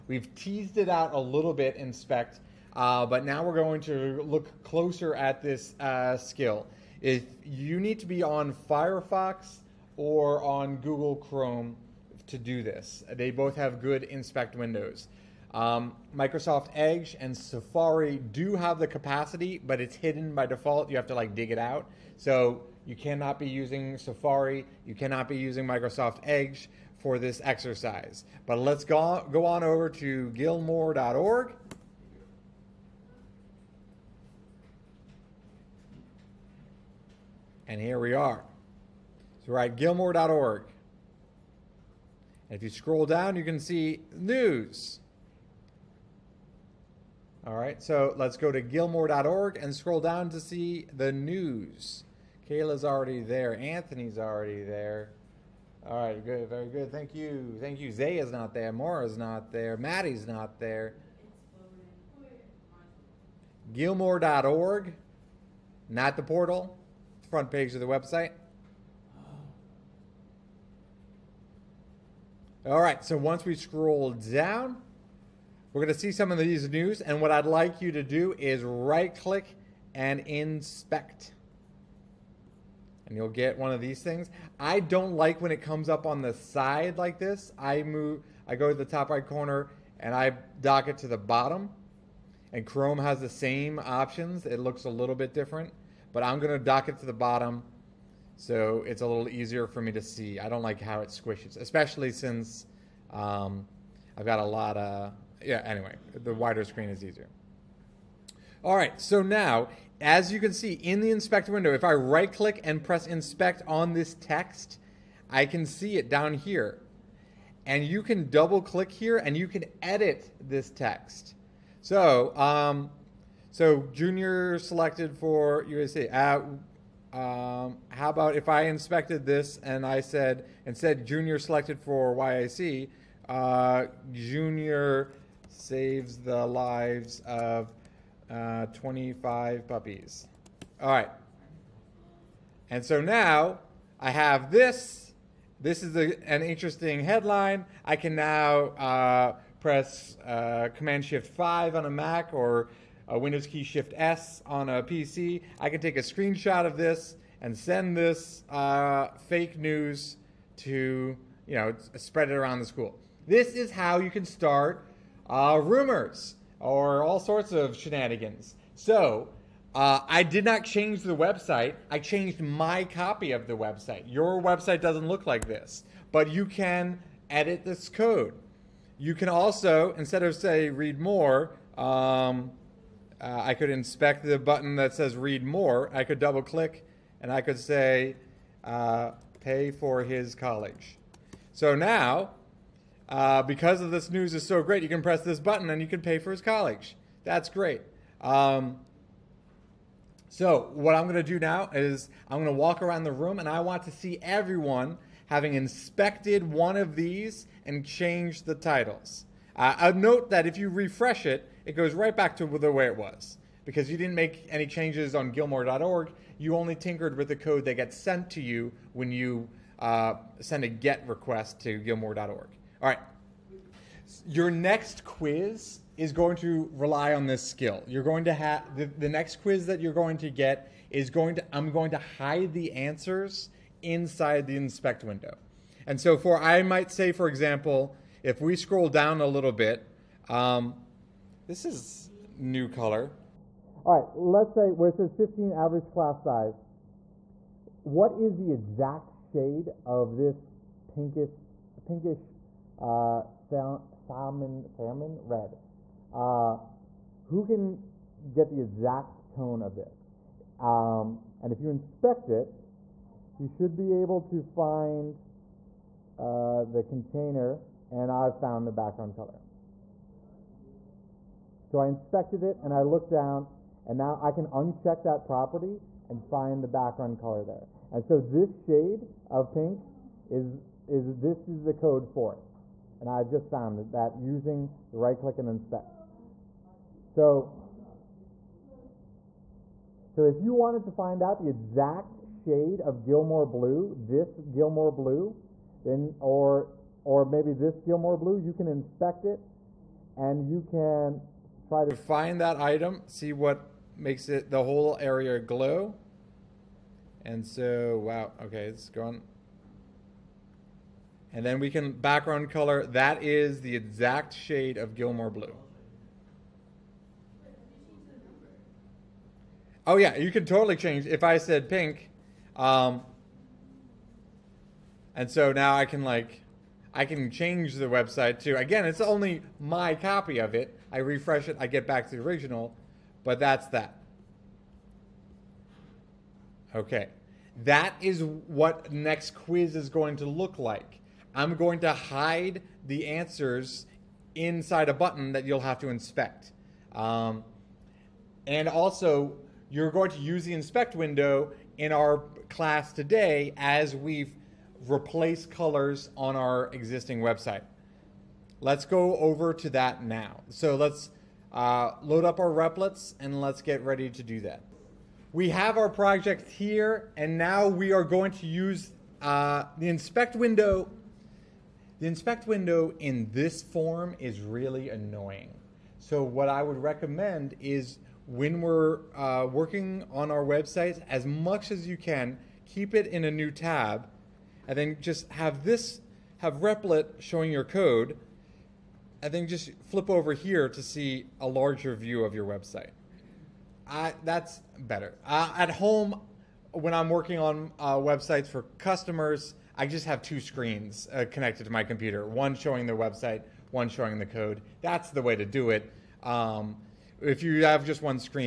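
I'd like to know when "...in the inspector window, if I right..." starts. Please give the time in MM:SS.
01:50.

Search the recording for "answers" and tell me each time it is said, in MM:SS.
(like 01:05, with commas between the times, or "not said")
03:52, 05:43.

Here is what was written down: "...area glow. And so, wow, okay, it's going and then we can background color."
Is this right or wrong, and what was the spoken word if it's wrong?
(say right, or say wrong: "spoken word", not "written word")
right.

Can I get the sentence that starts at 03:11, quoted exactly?
So now uh, because of this news is so great, you can press this button and you can pay for his college.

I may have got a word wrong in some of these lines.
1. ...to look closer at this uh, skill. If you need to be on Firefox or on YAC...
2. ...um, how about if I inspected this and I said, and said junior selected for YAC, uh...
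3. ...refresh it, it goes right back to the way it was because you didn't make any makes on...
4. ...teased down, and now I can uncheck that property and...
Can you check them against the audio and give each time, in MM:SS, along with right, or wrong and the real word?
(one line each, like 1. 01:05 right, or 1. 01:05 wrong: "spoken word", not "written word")
1. 00:03 wrong: "Google", not "YAC"
2. 02:07 right
3. 03:30 wrong: "changes", not "makes"
4. 04:32 wrong: "looked", not "teased".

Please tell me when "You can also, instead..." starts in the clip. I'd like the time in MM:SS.
02:58.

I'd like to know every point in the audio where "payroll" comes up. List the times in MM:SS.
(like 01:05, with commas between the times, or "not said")
not said.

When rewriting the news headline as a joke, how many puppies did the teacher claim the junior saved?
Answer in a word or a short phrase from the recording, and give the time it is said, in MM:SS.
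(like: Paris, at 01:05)
25, at 02:18.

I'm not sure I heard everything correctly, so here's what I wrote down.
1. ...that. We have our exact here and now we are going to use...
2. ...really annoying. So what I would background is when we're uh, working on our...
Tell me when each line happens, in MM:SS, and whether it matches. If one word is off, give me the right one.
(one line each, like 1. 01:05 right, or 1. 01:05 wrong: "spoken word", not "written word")
1. 06:04 wrong: "project", not "exact"
2. 06:14 wrong: "recommend", not "background".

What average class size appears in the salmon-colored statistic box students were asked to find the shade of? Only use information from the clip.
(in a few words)
15.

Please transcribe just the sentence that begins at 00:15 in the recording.
Um, Microsoft Edge and Safari do have the capacity, but it's hidden by default.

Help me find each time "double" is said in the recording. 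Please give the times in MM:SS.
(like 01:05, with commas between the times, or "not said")
01:58, 03:06.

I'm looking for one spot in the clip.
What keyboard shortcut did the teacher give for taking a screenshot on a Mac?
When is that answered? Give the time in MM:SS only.
02:30.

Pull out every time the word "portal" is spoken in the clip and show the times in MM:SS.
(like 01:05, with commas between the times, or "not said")
01:06.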